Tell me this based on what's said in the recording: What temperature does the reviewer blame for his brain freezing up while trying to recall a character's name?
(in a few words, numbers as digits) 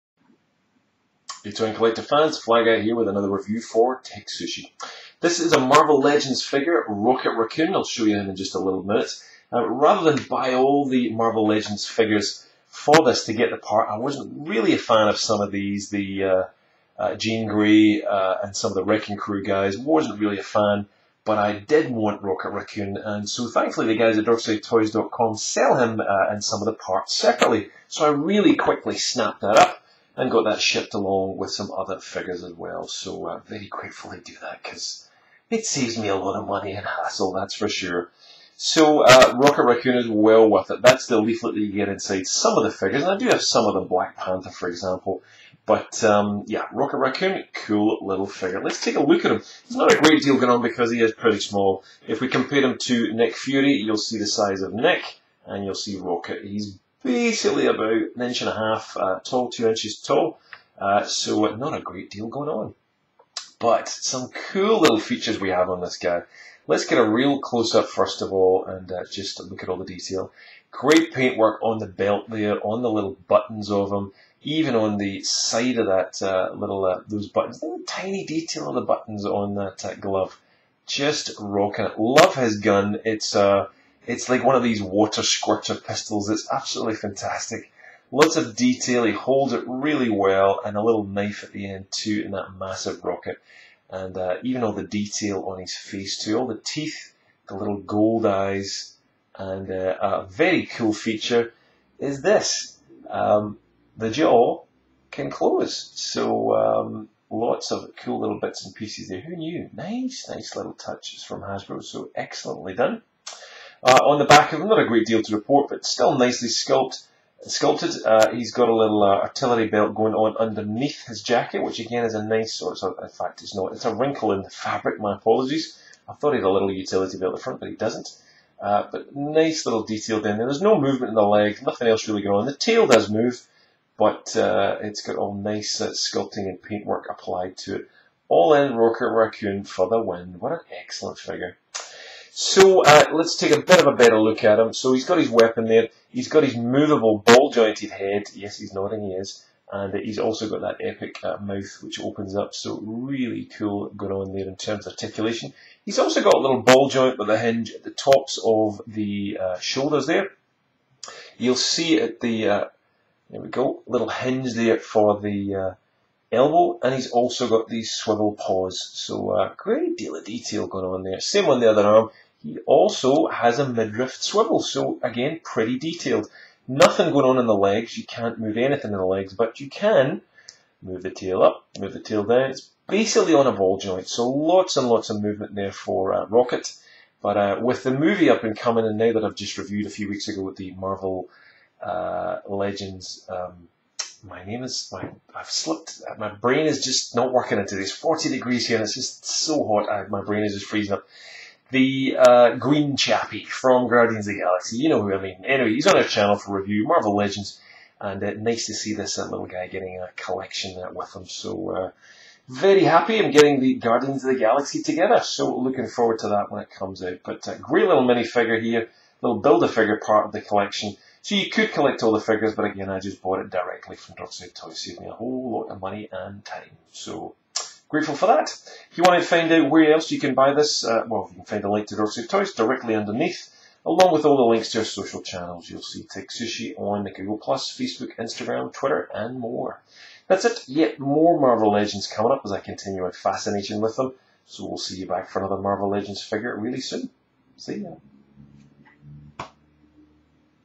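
40 degrees.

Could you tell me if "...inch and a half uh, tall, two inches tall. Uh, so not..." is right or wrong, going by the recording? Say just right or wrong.
right.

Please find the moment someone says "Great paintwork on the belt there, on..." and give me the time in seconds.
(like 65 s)
70 s.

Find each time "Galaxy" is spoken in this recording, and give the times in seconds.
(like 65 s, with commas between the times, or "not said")
204 s, 214 s.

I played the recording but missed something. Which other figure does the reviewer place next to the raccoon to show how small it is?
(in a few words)
Nick Fury.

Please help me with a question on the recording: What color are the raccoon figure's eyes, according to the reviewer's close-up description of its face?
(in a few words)
gold.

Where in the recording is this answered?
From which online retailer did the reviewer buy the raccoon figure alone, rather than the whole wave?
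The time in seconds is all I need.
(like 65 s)
24 s.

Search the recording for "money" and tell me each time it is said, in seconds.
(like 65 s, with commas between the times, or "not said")
36 s, 225 s.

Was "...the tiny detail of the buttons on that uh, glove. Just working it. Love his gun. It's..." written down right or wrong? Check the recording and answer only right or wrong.
wrong.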